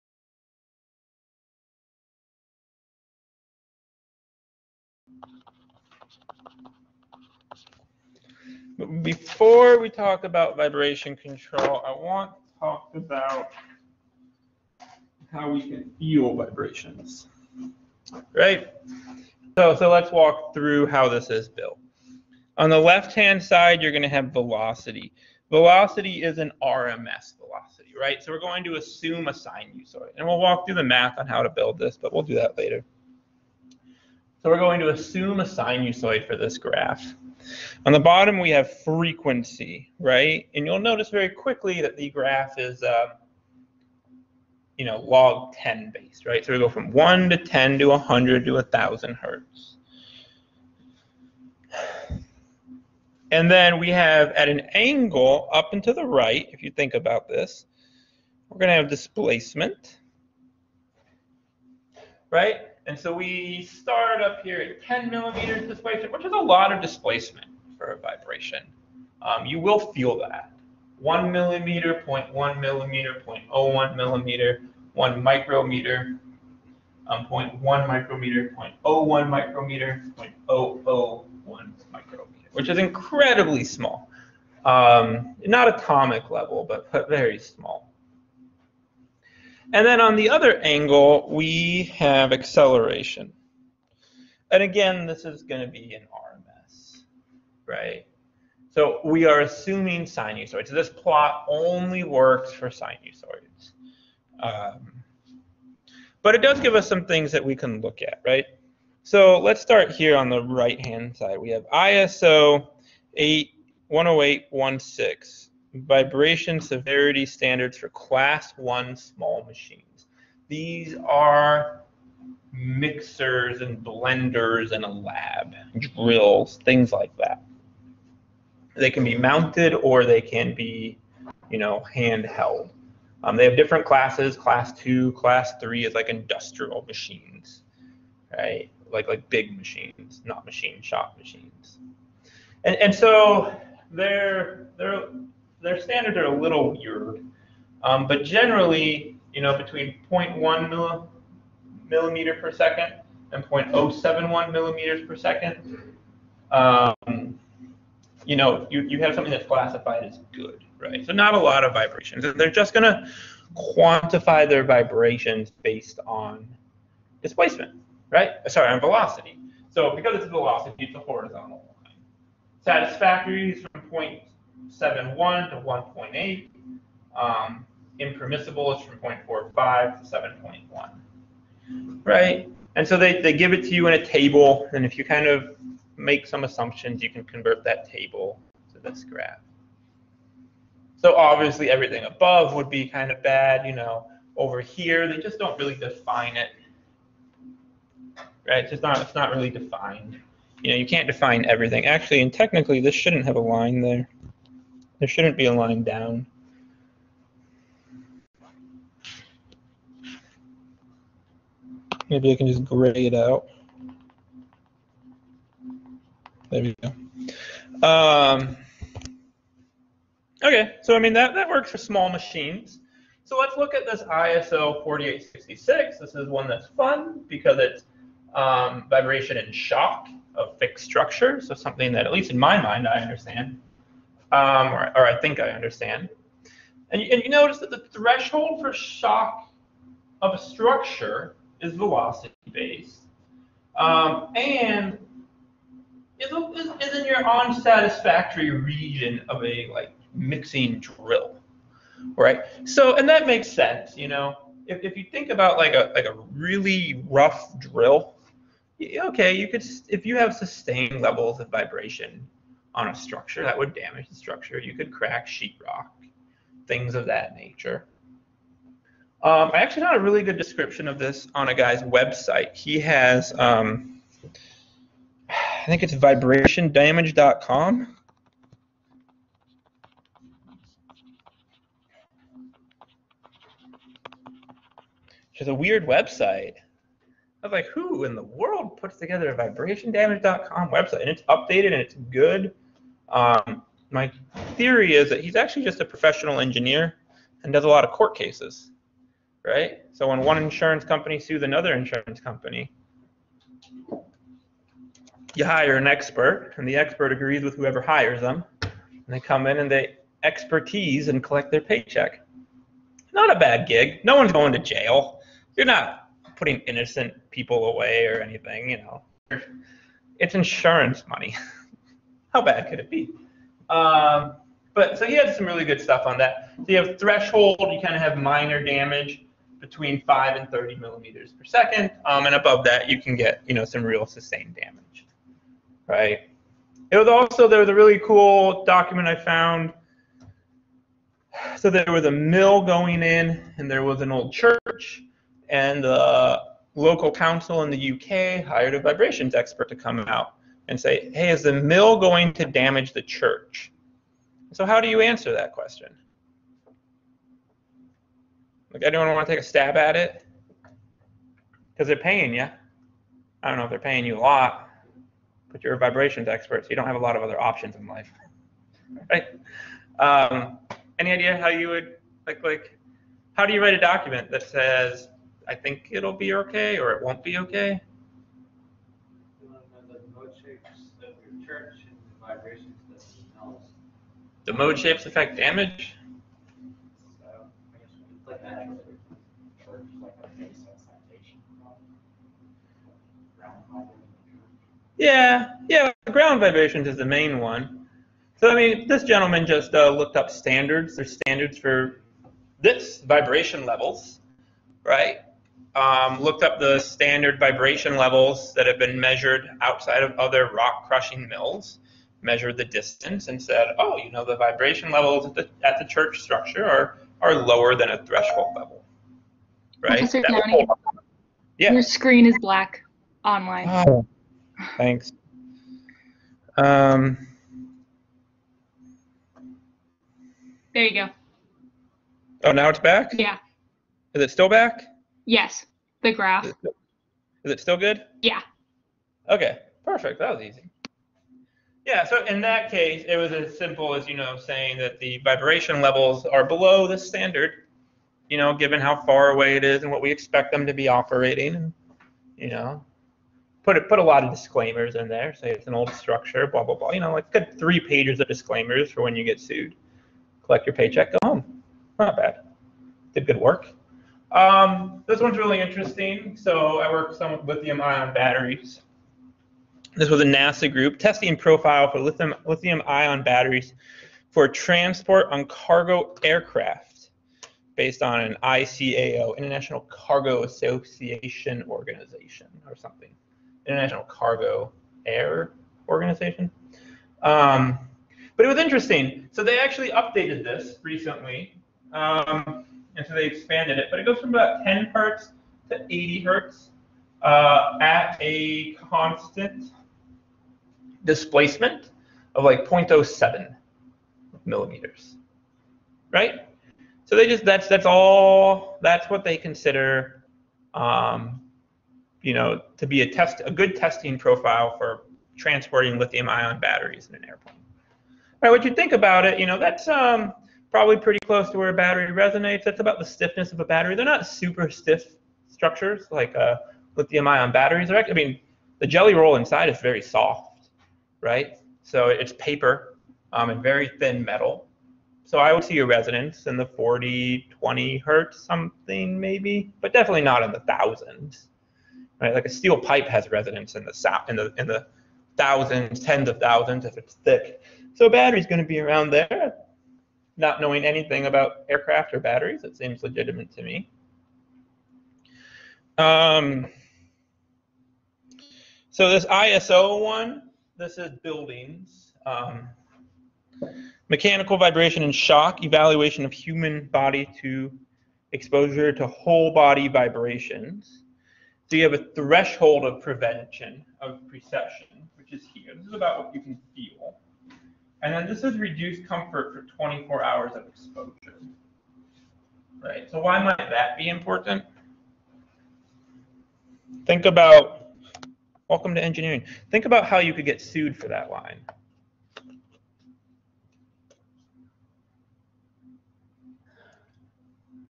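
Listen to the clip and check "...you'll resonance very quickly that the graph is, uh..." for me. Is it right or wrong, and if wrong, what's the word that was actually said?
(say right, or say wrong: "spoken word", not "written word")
wrong: "notice", not "resonance".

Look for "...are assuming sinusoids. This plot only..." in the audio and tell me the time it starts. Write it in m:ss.
1:39.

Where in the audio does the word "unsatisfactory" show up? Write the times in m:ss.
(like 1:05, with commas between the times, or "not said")
4:07.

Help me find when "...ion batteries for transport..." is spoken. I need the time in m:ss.
7:52.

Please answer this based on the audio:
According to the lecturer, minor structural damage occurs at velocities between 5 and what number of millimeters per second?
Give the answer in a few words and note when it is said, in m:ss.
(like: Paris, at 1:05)
30, at 5:30.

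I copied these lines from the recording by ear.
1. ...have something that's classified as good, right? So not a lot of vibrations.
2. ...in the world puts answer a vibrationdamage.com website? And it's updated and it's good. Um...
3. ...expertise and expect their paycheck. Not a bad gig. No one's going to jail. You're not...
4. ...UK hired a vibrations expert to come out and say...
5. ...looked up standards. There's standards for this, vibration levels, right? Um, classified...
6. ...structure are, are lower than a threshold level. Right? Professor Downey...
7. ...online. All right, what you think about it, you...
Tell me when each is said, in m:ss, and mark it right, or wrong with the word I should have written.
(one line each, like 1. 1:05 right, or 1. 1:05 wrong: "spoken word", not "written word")
1. 2:39 right
2. 4:48 wrong: "together", not "answer"
3. 5:10 wrong: "collect", not "expect"
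4. 5:47 right
5. 6:39 wrong: "looked", not "classified"
6. 6:56 right
7. 8:37 wrong: "airplane", not "online".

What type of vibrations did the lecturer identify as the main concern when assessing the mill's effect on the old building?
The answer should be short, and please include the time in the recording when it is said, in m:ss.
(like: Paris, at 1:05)
Ground vibrations, at 6:36.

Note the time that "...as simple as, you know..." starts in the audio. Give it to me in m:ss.
7:23.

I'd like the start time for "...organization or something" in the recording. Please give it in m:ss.
8:01.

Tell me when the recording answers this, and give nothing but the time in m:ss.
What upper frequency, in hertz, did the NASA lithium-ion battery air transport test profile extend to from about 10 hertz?
8:15.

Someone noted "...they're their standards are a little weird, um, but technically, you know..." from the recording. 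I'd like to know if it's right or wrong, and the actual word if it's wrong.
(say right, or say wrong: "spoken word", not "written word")
wrong: "generally", not "technically".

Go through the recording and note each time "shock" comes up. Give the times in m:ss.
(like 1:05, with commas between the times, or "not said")
3:49, 3:58, 9:25.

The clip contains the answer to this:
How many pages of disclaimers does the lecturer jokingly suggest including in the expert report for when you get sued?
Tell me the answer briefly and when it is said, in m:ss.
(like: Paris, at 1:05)
3, at 7:37.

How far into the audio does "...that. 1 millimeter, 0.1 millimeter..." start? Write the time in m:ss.
1:10.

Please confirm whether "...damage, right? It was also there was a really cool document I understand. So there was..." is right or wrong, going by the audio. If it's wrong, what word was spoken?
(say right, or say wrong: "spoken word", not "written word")
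wrong: "found", not "understand".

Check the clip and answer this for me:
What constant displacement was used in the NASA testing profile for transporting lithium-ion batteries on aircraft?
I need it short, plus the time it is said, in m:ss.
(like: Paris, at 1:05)
0.07 millimeters, at 8:22.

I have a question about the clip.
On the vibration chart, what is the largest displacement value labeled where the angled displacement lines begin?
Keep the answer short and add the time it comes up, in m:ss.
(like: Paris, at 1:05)
10 millimeters, at 1:04.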